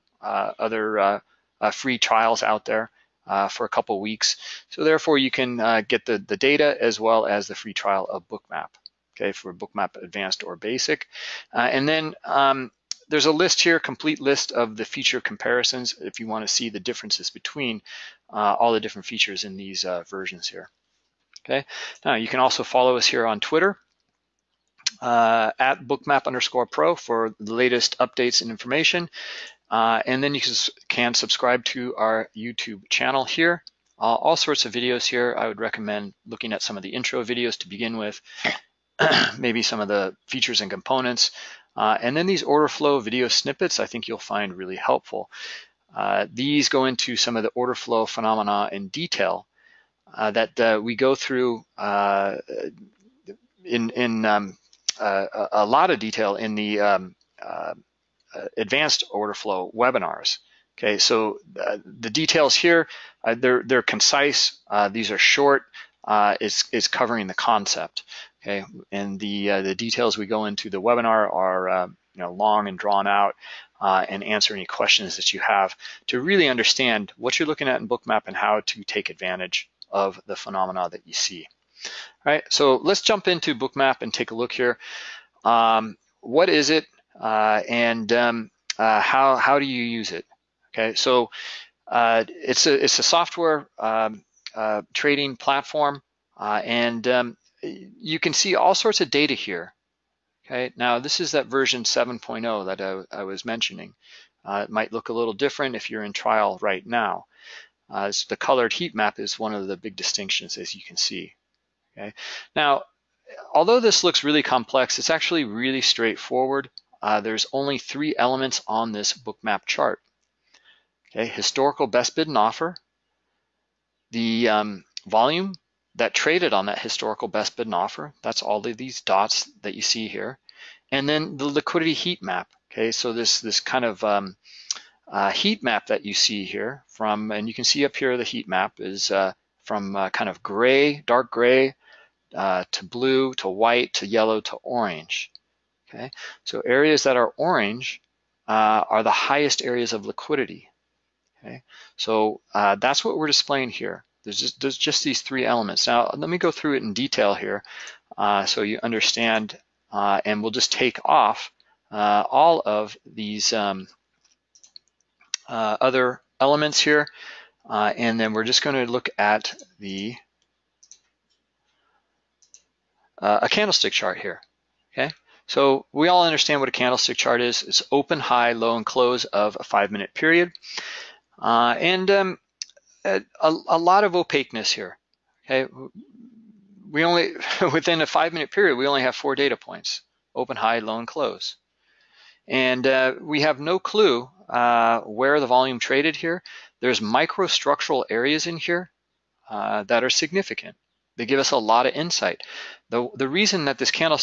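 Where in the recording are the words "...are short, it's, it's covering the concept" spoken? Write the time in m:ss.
1:05.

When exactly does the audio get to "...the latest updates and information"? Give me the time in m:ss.
0:27.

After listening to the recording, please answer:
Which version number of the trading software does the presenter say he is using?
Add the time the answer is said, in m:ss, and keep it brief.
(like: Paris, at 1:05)
7.0, at 1:41.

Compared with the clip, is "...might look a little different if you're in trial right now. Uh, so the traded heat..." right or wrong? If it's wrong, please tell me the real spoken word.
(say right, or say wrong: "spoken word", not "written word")
wrong: "colored", not "traded".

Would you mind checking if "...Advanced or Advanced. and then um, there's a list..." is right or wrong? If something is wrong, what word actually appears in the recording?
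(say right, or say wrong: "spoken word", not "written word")
wrong: "Basic", not "Advanced".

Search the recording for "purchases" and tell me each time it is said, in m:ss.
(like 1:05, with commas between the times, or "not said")
not said.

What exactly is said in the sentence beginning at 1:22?
All right, so let's jump into Bookmap and take a look here.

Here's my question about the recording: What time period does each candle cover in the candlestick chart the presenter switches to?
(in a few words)
5 minutes.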